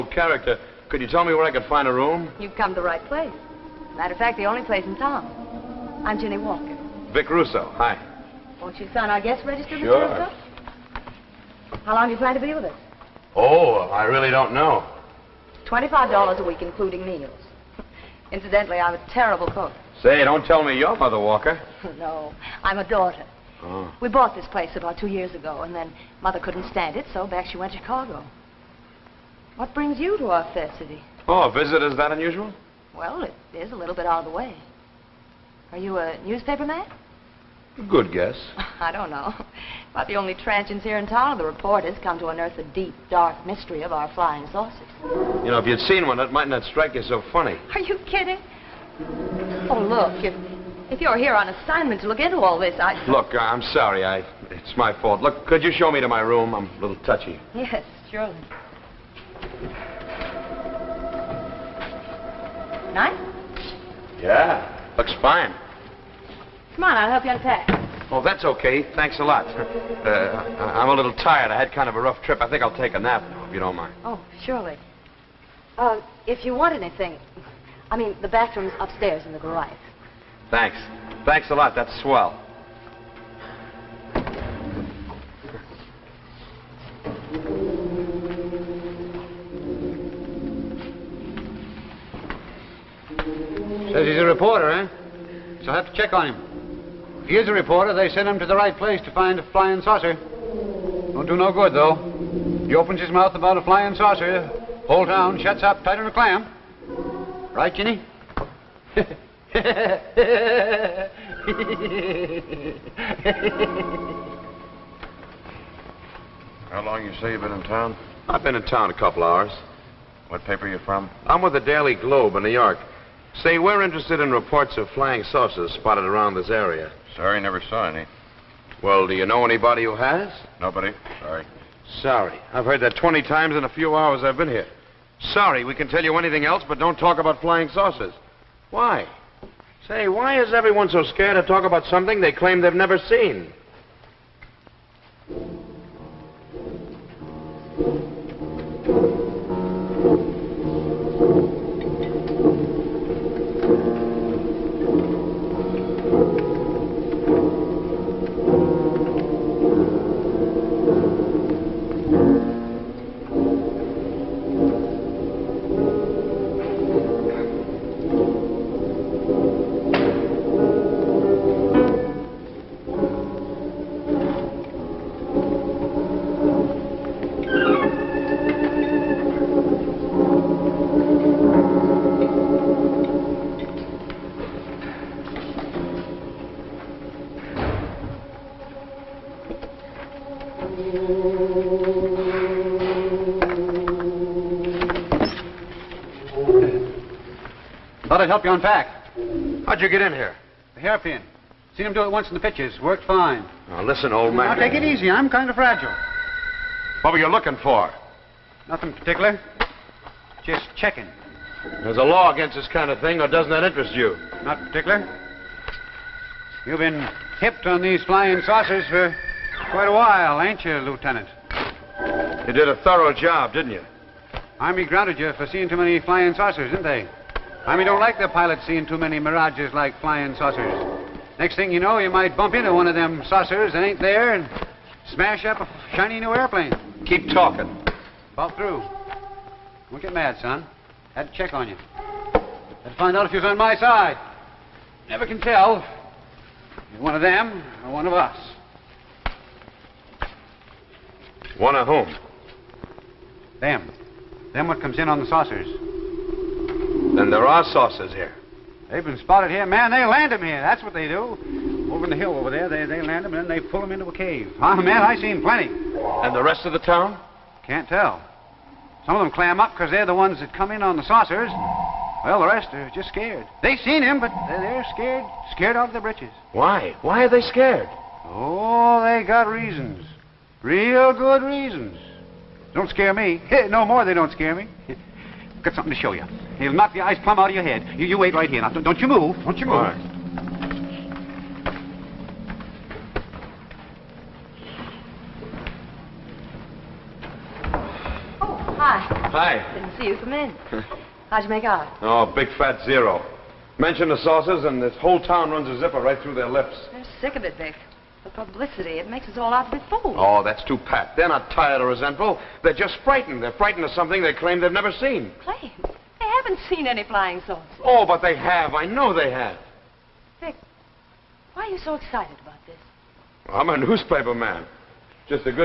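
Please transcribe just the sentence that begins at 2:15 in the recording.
Sorry, we can tell you anything else, but don't talk about flying saucers.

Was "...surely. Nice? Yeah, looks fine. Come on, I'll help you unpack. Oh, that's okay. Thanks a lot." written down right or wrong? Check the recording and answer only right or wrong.
right.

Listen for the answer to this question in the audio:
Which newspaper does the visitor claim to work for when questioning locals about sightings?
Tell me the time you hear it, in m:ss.
2:01.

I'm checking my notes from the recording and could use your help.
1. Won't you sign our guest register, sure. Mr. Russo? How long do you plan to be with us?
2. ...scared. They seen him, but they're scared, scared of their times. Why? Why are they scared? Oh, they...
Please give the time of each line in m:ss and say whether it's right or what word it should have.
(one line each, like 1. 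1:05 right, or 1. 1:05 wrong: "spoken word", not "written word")
1. 0:08 right
2. 4:33 wrong: "britches", not "times".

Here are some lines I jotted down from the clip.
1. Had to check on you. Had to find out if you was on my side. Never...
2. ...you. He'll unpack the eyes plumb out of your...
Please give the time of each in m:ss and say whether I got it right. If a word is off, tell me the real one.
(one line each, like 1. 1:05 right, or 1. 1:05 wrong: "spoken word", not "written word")
1. 4:01 right
2. 4:46 wrong: "knock", not "unpack".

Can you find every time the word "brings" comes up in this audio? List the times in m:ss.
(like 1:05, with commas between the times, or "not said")
0:29.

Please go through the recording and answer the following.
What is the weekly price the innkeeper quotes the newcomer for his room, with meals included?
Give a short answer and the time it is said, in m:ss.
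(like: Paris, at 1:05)
$25, at 0:15.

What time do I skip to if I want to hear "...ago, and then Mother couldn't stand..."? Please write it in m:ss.
0:25.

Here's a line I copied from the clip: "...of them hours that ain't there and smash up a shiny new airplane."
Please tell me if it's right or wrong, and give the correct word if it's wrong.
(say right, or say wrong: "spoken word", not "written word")
wrong: "saucers", not "hours".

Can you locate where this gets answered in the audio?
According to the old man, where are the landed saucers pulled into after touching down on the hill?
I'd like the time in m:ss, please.
4:24.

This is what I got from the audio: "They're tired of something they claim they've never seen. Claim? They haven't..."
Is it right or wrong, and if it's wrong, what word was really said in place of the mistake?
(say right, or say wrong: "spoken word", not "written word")
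wrong: "frightened", not "tired".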